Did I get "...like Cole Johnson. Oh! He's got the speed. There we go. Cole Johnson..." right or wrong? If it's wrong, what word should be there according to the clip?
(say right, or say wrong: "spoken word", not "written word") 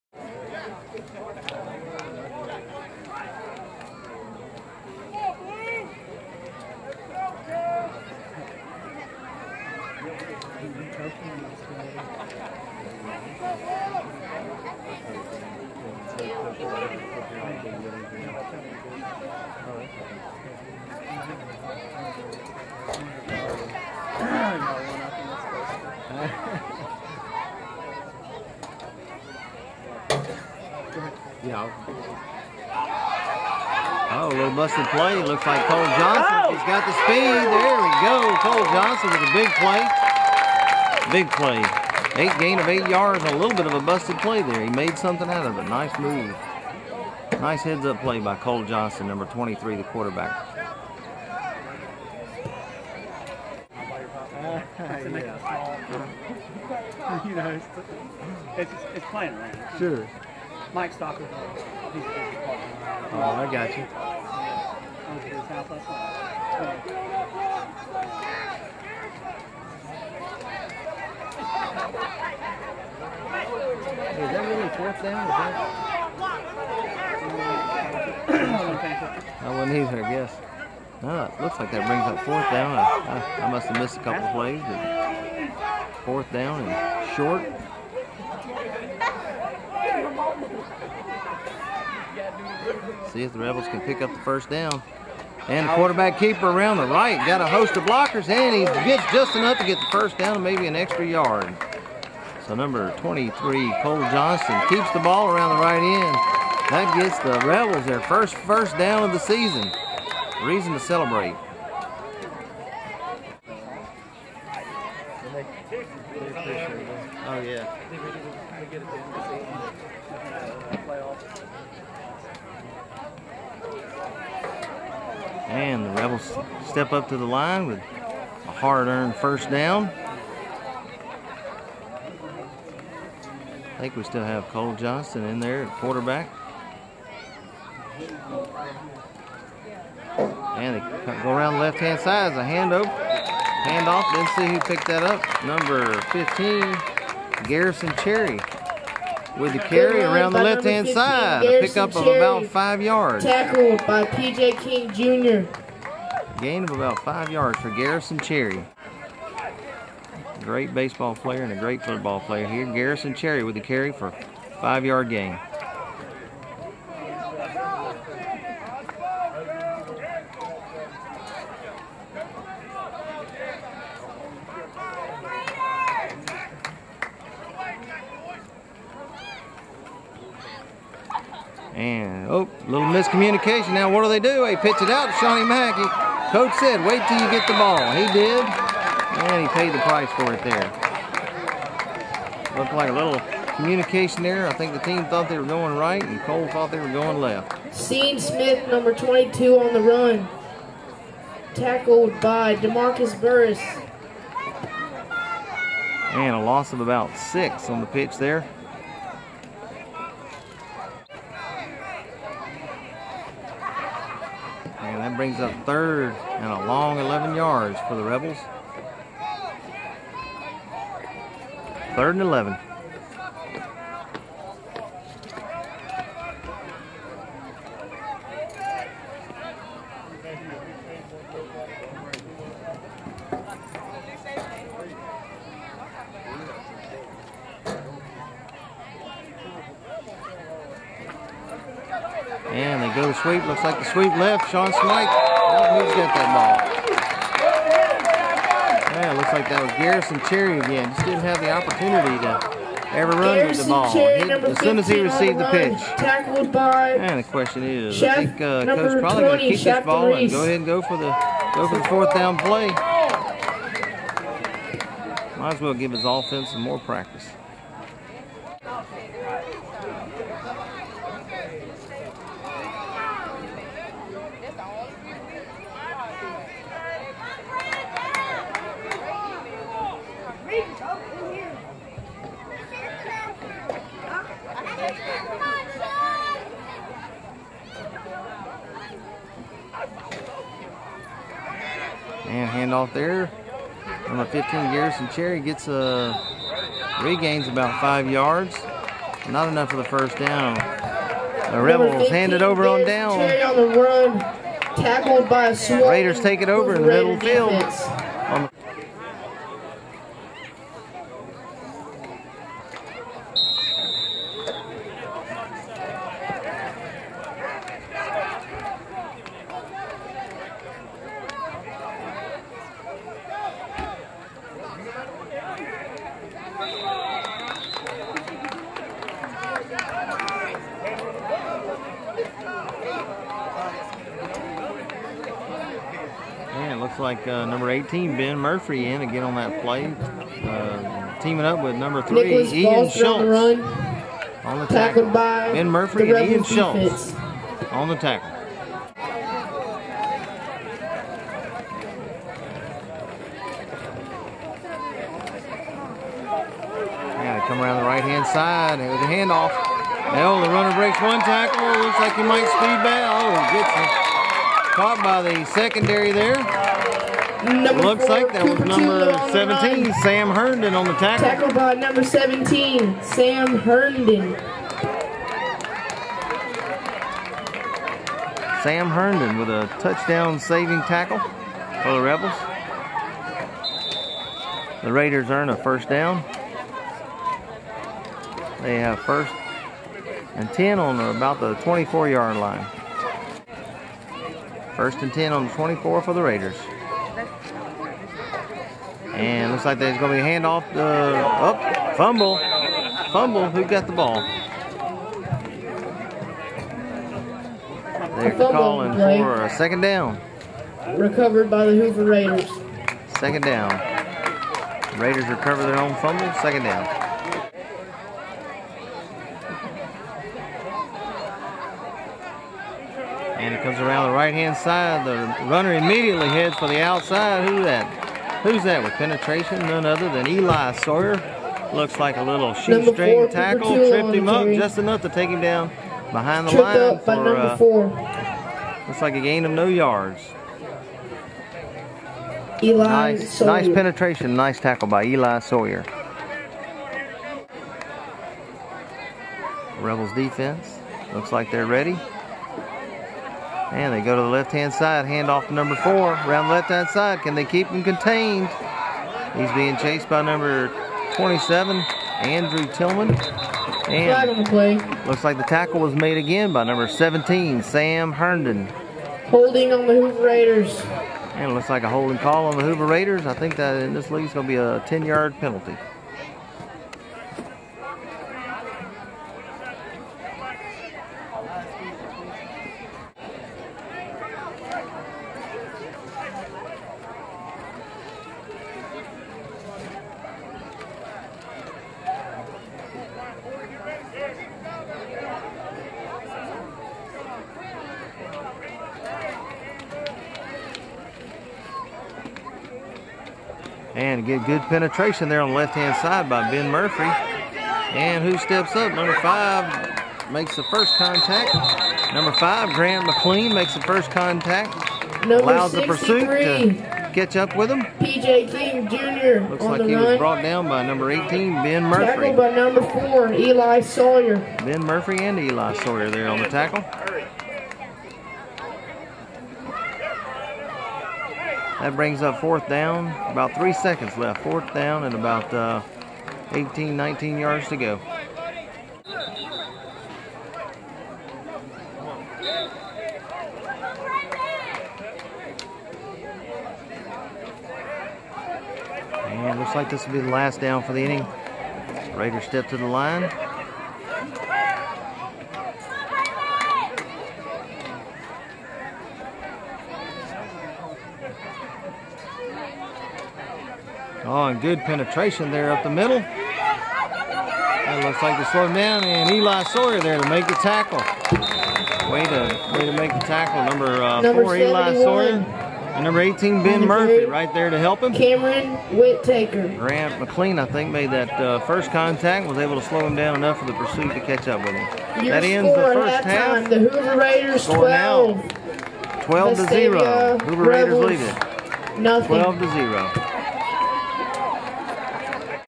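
right.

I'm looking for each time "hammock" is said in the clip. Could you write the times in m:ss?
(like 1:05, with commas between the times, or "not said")
not said.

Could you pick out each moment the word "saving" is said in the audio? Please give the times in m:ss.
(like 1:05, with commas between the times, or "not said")
6:20.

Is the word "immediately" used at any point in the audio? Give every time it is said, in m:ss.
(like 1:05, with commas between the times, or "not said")
7:05.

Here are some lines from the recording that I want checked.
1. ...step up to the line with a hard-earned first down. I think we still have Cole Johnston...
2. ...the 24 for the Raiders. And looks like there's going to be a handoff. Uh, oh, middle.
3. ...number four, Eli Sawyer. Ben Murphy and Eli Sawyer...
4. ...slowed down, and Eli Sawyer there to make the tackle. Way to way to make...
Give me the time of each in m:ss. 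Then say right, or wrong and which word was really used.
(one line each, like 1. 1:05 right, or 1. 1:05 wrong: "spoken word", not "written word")
1. 2:06 right
2. 6:35 wrong: "fumble", not "middle"
3. 8:42 right
4. 9:28 right.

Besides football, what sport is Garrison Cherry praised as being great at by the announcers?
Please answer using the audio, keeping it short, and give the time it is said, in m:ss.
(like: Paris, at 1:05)
Baseball, at 2:40.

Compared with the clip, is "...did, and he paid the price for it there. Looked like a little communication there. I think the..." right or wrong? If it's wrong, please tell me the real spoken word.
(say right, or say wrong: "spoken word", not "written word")
right.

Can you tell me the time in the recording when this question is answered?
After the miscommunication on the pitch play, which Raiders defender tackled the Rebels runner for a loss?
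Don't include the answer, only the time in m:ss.
3:22.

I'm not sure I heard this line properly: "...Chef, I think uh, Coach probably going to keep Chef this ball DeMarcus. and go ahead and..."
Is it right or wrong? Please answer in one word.
wrong.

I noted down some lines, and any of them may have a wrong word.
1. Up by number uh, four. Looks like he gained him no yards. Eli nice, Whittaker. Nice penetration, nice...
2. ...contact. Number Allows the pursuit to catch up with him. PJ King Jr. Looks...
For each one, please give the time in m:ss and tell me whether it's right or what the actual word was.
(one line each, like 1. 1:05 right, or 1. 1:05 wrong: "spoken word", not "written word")
1. 7:16 wrong: "Sawyer", not "Whittaker"
2. 8:34 right.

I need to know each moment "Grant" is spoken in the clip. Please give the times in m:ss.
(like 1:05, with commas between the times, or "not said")
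8:32, 9:39.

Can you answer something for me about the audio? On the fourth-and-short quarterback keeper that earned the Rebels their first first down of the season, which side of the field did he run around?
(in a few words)
Right end.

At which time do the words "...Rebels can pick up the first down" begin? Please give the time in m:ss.
1:33.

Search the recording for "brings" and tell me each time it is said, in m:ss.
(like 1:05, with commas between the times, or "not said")
1:21, 3:35, 8:51.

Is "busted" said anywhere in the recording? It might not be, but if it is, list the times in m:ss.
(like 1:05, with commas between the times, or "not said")
0:34, 0:43.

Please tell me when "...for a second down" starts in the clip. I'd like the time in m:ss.
6:48.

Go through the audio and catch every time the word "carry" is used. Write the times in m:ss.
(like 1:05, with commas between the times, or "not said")
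2:29, 2:43.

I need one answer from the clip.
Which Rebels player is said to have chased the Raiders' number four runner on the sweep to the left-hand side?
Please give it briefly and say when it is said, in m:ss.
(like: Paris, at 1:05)
Andrew Tillman, at 7:42.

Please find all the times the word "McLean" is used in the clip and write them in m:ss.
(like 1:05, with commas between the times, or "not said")
8:33, 9:40.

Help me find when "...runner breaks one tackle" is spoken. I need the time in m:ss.
6:00.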